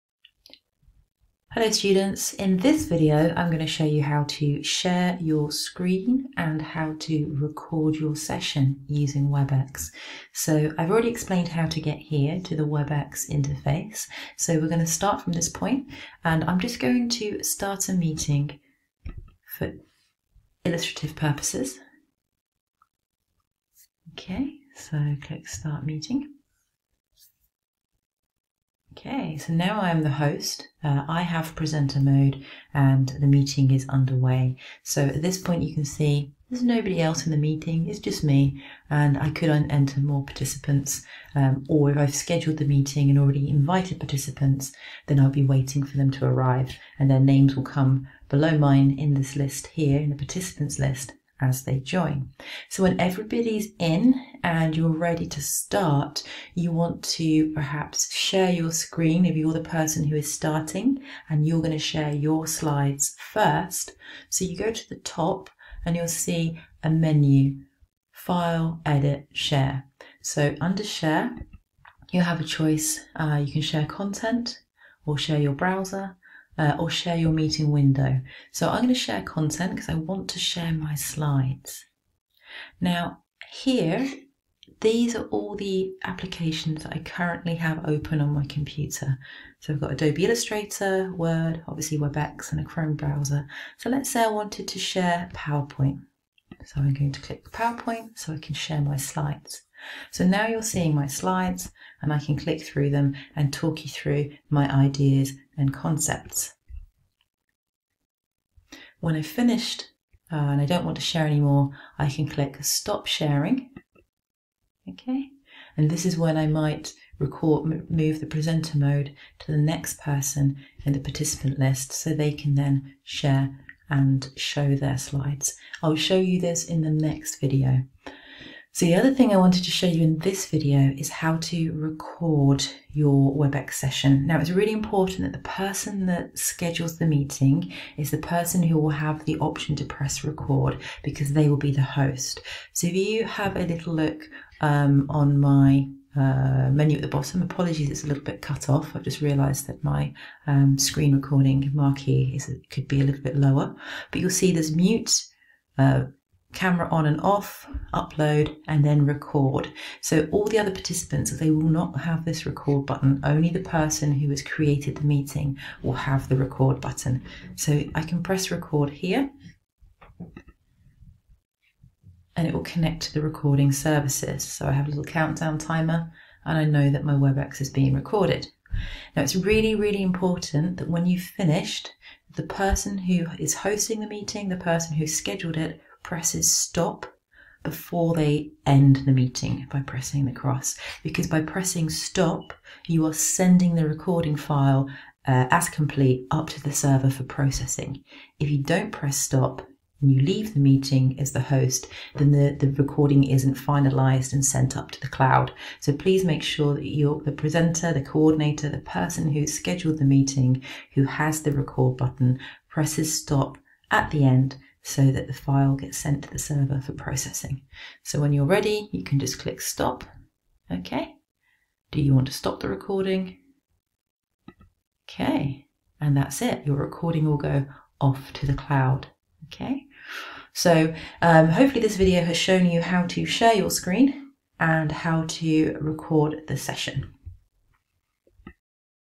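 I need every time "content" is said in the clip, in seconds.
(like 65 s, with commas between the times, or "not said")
73 s, 79 s.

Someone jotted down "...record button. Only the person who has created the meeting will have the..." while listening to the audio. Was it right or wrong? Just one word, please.
right.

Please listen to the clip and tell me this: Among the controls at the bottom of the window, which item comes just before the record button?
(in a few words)
upload.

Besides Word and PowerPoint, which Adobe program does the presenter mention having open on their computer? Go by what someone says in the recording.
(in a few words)
Adobe Illustrator.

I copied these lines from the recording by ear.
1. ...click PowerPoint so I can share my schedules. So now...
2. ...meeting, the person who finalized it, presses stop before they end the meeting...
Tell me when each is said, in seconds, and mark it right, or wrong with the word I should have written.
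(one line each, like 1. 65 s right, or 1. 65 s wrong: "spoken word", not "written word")
1. 97 s wrong: "slides", not "schedules"
2. 184 s wrong: "scheduled", not "finalized".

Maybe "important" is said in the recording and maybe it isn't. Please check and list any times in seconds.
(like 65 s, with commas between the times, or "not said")
134 s, 180 s.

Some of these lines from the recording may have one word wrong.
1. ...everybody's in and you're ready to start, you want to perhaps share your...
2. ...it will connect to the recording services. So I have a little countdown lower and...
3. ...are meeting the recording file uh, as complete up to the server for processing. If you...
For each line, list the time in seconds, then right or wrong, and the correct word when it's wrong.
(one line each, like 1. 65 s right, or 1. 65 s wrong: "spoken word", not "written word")
1. 52 s right
2. 172 s wrong: "timer", not "lower"
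3. 193 s wrong: "sending", not "meeting".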